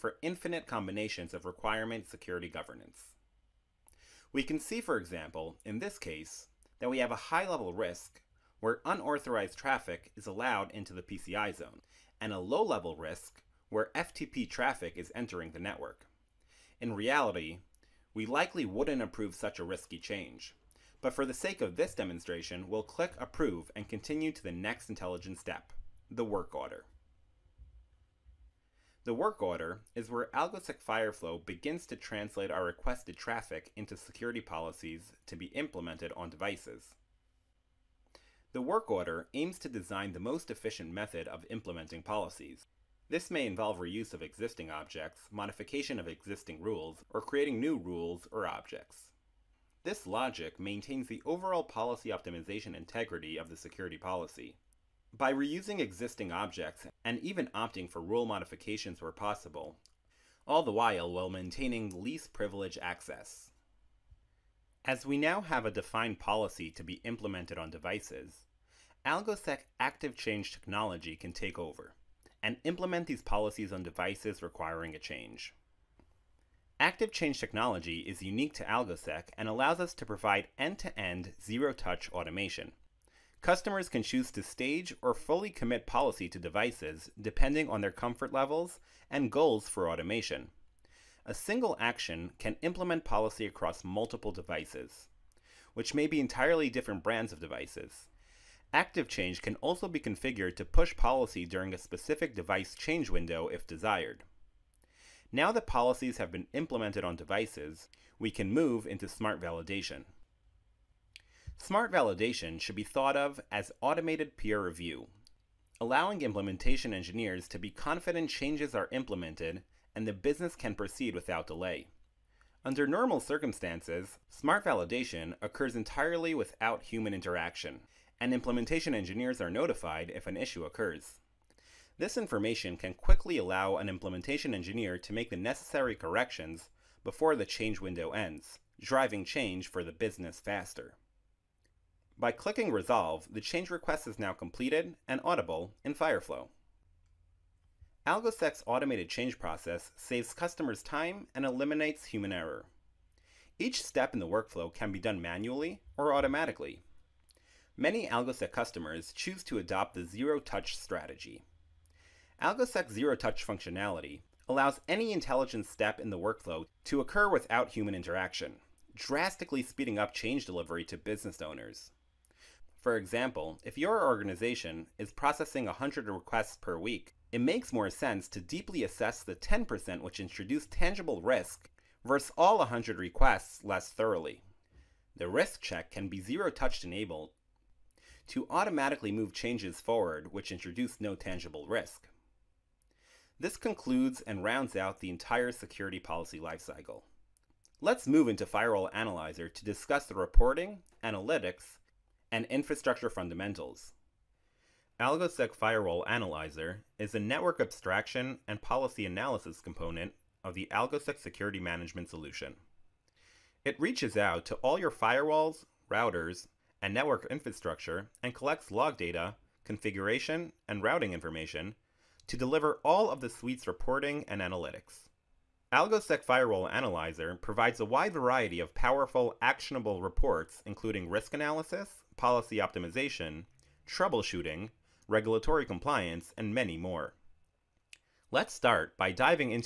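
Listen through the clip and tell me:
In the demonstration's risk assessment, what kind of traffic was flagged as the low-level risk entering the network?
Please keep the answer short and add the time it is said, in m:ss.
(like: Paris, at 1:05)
FTP traffic, at 0:13.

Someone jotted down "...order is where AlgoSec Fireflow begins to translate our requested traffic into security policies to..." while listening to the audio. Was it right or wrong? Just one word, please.
right.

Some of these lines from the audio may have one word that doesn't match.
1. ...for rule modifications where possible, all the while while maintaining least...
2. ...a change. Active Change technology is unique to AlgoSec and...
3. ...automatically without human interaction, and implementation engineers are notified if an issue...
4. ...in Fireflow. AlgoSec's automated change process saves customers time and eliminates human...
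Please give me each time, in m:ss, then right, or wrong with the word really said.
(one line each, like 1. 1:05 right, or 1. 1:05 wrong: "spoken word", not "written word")
1. 0:57 right
2. 1:14 right
3. 2:05 wrong: "entirely", not "automatically"
4. 2:25 right.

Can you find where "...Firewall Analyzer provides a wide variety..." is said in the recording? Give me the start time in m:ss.
3:46.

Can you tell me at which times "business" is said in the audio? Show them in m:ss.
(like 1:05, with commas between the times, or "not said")
2:00, 2:19, 2:50.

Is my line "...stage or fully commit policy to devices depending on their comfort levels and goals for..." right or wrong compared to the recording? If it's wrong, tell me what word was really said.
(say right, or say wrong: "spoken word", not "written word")
right.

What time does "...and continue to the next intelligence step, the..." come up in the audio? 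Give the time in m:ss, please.
0:23.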